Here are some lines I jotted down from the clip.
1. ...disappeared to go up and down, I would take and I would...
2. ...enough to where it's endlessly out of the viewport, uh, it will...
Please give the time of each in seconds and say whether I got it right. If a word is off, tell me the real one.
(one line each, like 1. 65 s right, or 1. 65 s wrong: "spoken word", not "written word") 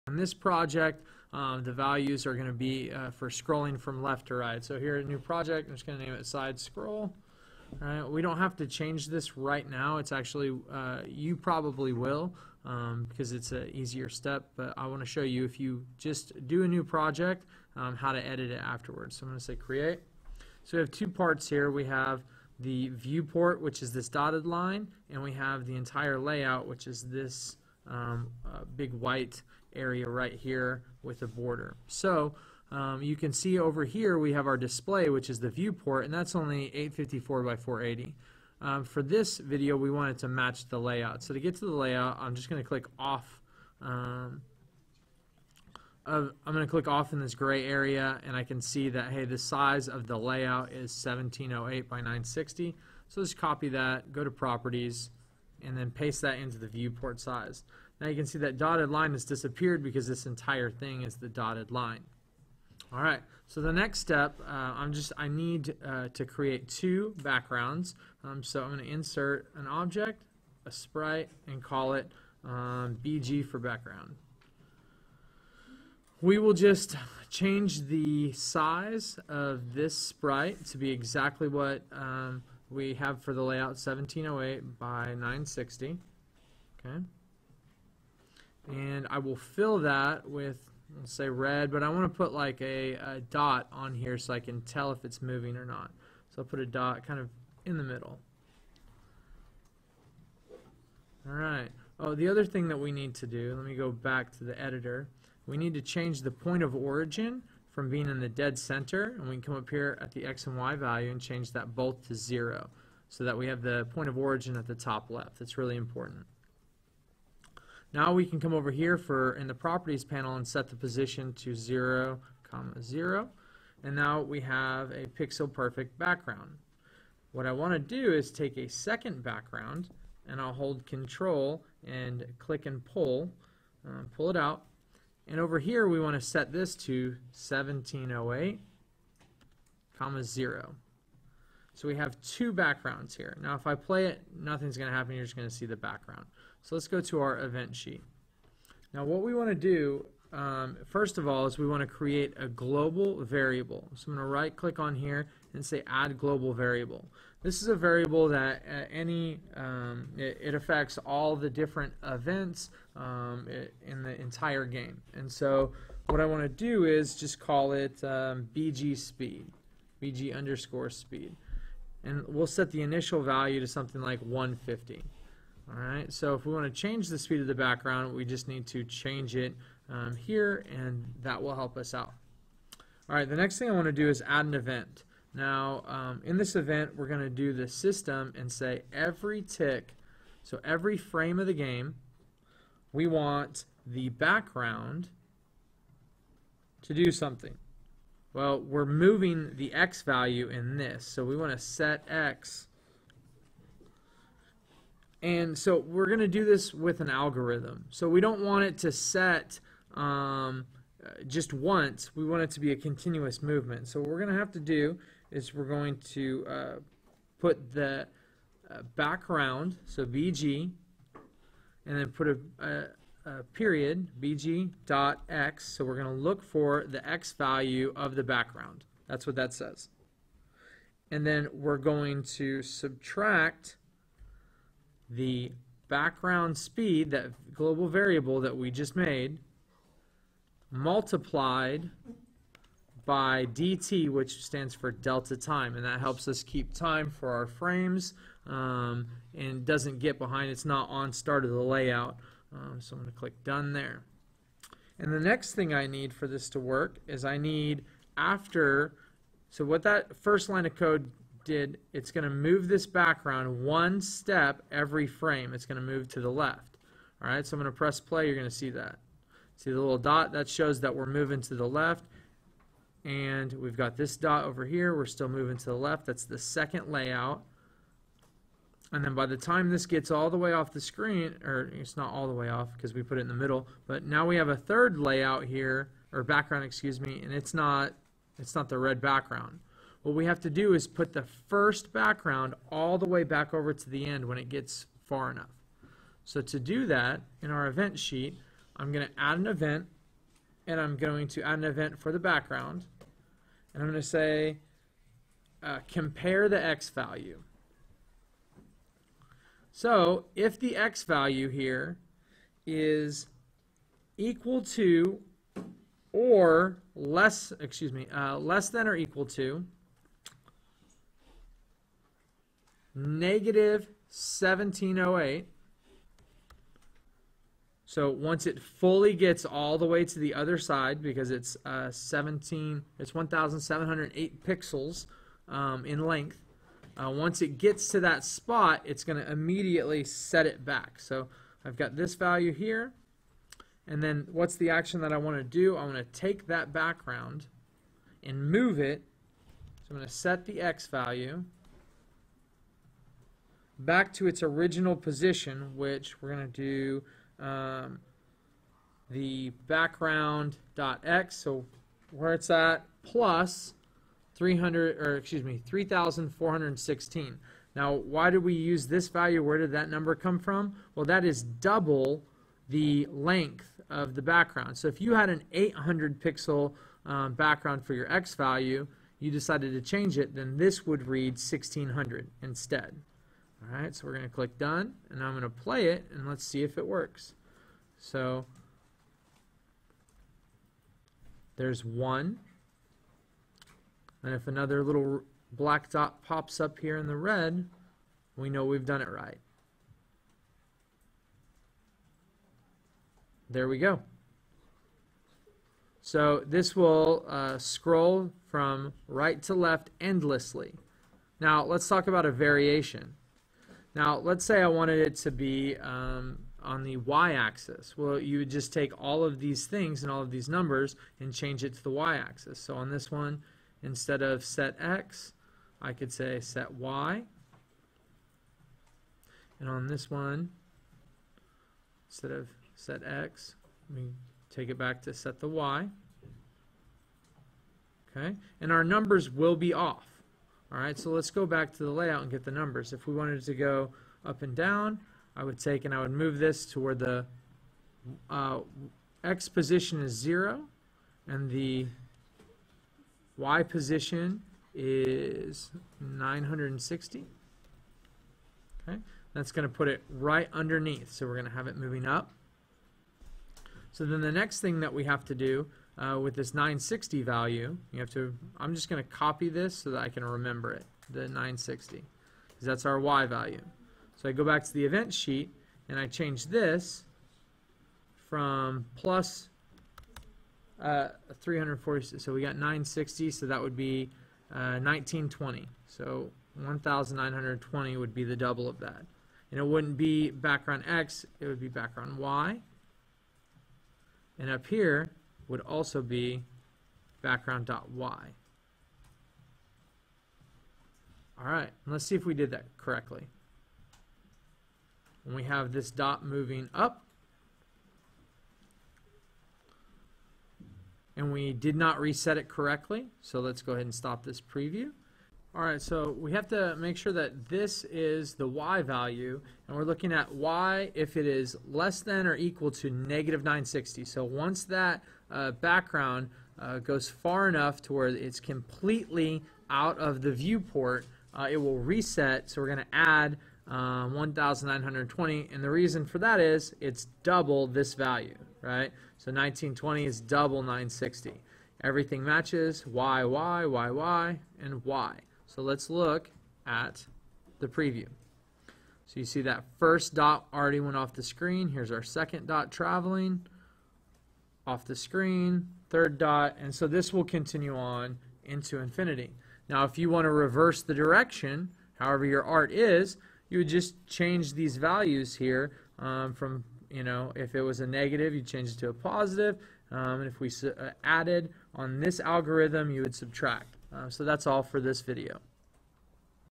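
1. 443 s wrong: "wanted", not "disappeared"
2. 527 s wrong: "completely", not "endlessly".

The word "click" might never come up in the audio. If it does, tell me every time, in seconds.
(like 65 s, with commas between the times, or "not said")
42 s, 46 s, 132 s, 154 s, 253 s, 384 s.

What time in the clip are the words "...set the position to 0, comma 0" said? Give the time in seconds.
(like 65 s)
120 s.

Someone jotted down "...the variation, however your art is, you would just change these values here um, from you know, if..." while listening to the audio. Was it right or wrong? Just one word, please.
wrong.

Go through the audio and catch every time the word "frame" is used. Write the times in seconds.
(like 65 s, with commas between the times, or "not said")
190 s, 247 s, 265 s.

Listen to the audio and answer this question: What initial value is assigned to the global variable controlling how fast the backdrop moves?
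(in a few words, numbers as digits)
150.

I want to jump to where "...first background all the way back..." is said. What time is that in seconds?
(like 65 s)
291 s.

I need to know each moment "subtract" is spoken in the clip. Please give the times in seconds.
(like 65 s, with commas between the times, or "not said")
232 s, 573 s.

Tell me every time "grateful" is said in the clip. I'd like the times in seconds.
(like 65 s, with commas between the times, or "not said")
not said.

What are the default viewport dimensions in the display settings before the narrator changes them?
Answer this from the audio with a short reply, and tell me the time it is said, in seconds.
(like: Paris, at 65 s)
854 by 480, at 36 s.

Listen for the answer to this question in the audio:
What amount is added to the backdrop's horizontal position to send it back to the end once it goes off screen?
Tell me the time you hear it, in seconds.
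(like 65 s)
365 s.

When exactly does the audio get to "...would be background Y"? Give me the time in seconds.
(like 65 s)
491 s.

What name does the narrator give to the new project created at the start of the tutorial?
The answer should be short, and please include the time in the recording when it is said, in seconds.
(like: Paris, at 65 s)
side scroll, at 6 s.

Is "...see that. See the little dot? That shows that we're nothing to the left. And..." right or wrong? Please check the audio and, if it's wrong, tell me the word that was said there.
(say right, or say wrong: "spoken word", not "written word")
wrong: "moving", not "nothing".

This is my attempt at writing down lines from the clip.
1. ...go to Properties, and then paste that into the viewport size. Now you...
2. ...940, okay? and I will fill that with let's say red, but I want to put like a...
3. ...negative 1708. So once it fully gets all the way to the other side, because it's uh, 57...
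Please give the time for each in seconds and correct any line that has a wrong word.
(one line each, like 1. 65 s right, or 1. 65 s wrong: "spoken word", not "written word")
1. 54 s right
2. 85 s wrong: "960", not "940"
3. 322 s wrong: "17", not "57".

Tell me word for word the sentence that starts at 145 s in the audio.
You're just going to see the background.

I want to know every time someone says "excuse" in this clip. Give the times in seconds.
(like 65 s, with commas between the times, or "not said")
286 s, 317 s, 365 s.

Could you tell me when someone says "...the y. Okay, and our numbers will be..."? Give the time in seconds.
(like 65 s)
435 s.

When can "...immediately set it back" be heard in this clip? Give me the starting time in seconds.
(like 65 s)
339 s.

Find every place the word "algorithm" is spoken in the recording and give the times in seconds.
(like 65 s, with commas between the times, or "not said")
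207 s, 572 s.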